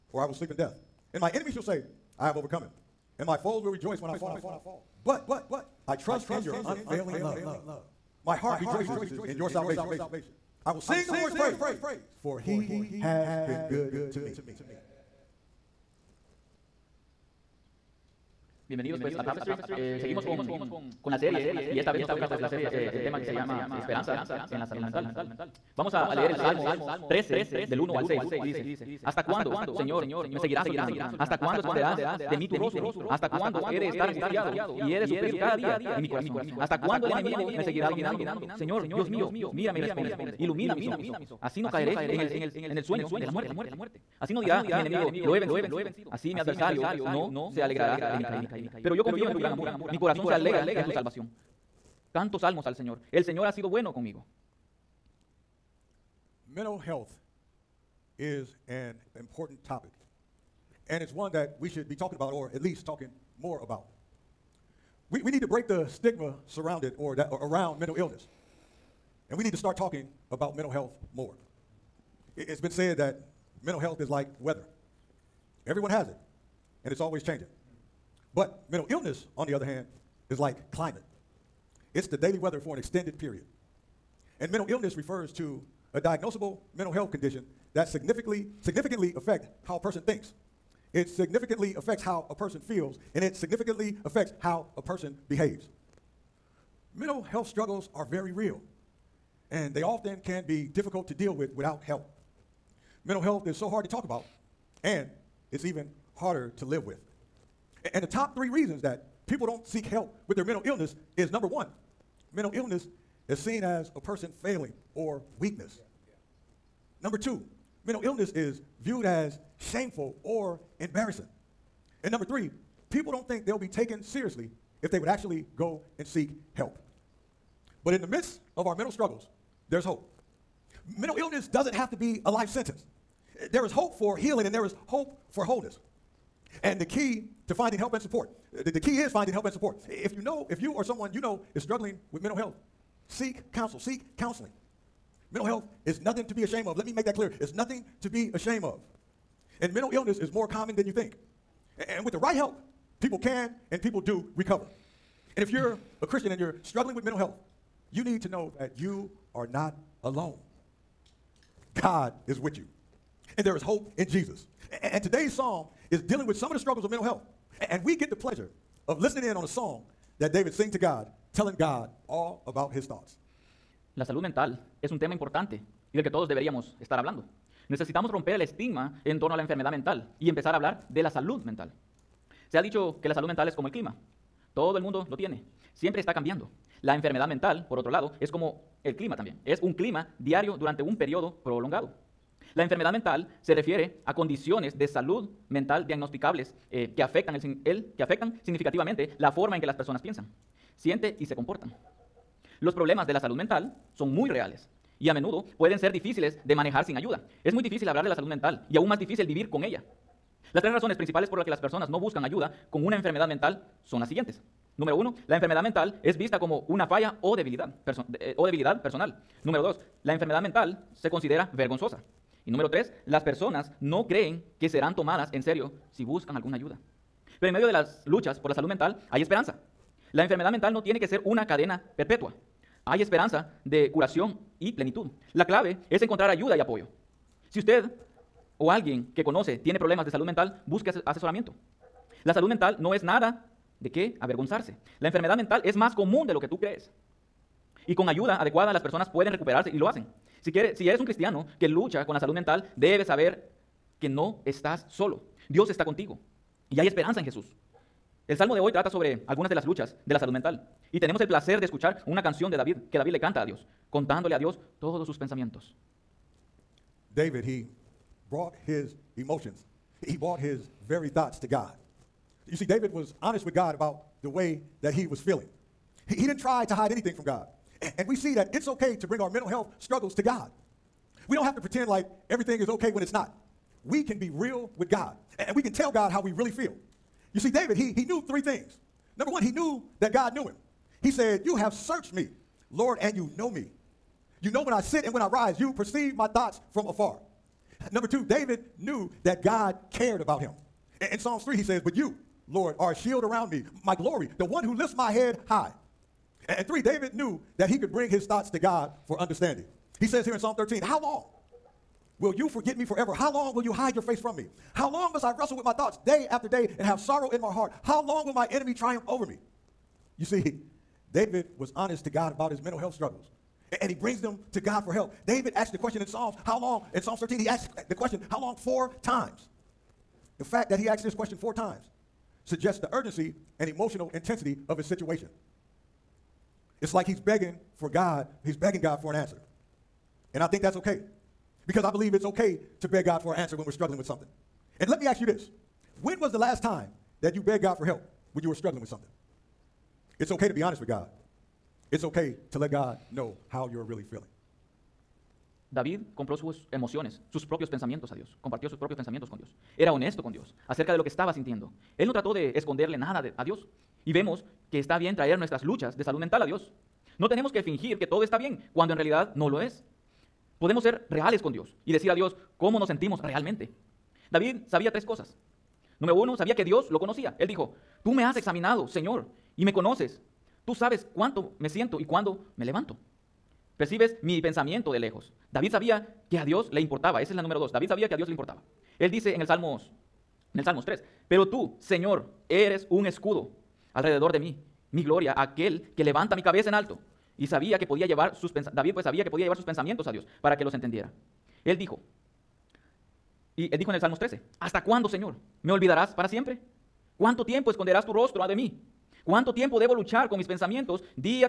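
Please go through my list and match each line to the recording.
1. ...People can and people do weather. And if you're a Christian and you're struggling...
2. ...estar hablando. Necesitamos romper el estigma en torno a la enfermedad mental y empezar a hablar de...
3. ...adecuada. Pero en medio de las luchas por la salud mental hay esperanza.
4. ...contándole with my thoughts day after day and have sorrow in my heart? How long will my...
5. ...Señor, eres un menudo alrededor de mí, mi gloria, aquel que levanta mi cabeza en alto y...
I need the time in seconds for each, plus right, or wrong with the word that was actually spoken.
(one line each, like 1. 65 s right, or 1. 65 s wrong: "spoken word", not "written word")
1. 153 s wrong: "recover", not "weather"
2. 176 s right
3. 226 s wrong: "ayuda", not "adecuada"
4. 315 s wrong: "wrestle", not "contándole"
5. 391 s wrong: "escudo", not "menudo".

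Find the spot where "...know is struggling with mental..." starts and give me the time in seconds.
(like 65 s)
141 s.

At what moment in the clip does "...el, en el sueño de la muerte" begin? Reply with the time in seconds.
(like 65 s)
42 s.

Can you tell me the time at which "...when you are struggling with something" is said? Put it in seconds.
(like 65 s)
348 s.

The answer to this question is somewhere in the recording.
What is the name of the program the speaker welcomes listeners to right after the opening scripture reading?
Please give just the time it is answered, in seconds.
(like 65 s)
19 s.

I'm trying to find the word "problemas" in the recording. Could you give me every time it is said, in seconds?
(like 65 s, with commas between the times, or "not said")
202 s, 239 s.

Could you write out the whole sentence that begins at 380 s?
Tú sabes cuánto me siento y cuándo me levanto.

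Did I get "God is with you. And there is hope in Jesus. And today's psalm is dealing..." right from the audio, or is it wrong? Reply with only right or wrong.
right.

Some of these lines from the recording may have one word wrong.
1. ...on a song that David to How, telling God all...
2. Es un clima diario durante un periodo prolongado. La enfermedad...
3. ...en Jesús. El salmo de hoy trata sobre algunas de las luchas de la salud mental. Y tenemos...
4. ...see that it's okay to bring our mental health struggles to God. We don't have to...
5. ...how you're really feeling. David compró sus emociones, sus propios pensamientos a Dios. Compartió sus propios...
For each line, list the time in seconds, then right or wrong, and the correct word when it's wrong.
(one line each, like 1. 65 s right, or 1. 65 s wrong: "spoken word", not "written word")
1. 169 s wrong: "God", not "How"
2. 189 s right
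3. 257 s right
4. 278 s right
5. 353 s right.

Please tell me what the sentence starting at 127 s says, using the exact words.
But in the midst of our mental struggles, there's hope.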